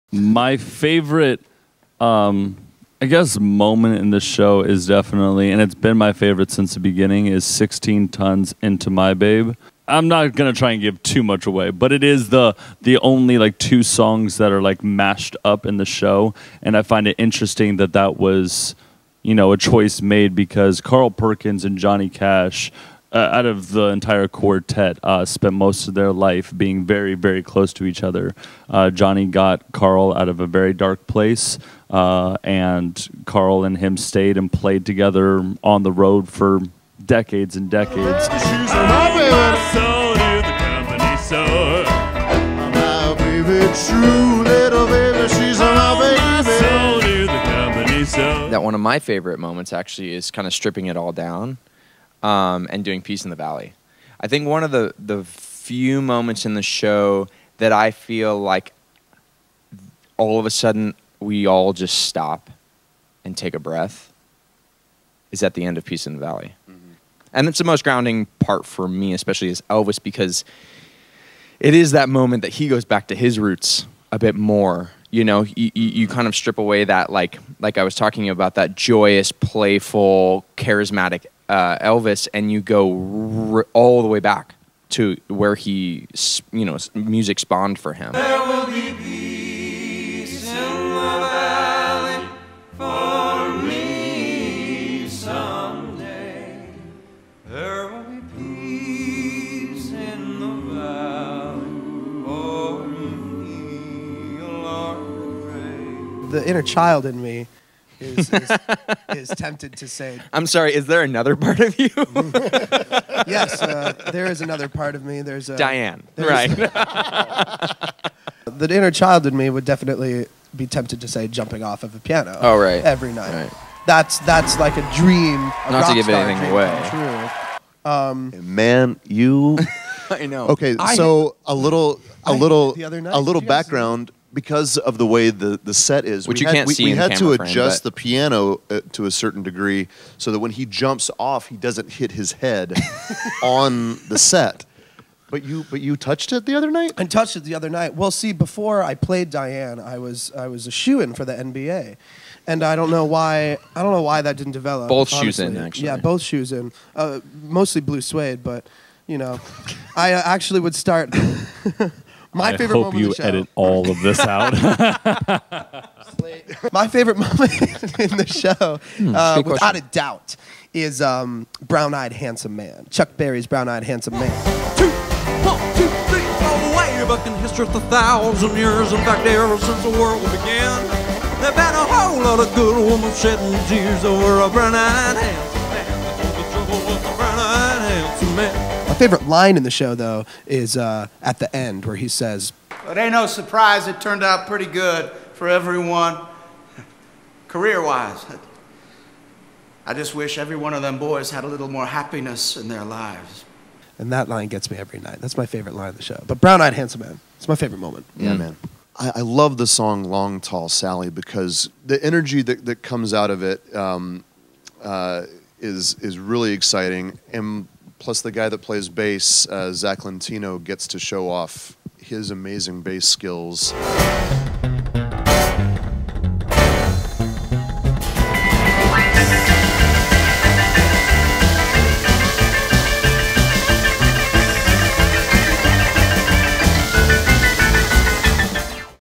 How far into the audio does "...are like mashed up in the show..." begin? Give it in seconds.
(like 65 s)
14 s.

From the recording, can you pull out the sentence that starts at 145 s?
But you, but you touched it the other night.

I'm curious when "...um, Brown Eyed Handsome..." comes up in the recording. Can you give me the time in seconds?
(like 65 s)
171 s.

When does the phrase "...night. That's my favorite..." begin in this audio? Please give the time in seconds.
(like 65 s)
204 s.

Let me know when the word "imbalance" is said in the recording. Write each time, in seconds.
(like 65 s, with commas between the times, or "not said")
not said.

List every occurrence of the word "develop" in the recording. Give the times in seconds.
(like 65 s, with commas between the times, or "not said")
154 s.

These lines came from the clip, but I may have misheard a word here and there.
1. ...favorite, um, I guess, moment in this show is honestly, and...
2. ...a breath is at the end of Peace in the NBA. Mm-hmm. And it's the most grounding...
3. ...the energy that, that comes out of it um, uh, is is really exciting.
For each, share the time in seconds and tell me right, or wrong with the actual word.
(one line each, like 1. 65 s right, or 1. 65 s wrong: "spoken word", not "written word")
1. 0 s wrong: "definitely", not "honestly"
2. 63 s wrong: "Valley", not "NBA"
3. 211 s right.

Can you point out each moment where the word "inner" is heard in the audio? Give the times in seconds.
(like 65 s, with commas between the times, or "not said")
118 s.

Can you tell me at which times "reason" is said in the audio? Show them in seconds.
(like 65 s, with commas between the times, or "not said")
not said.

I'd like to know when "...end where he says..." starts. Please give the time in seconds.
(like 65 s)
191 s.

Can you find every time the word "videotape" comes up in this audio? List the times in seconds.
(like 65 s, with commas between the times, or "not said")
not said.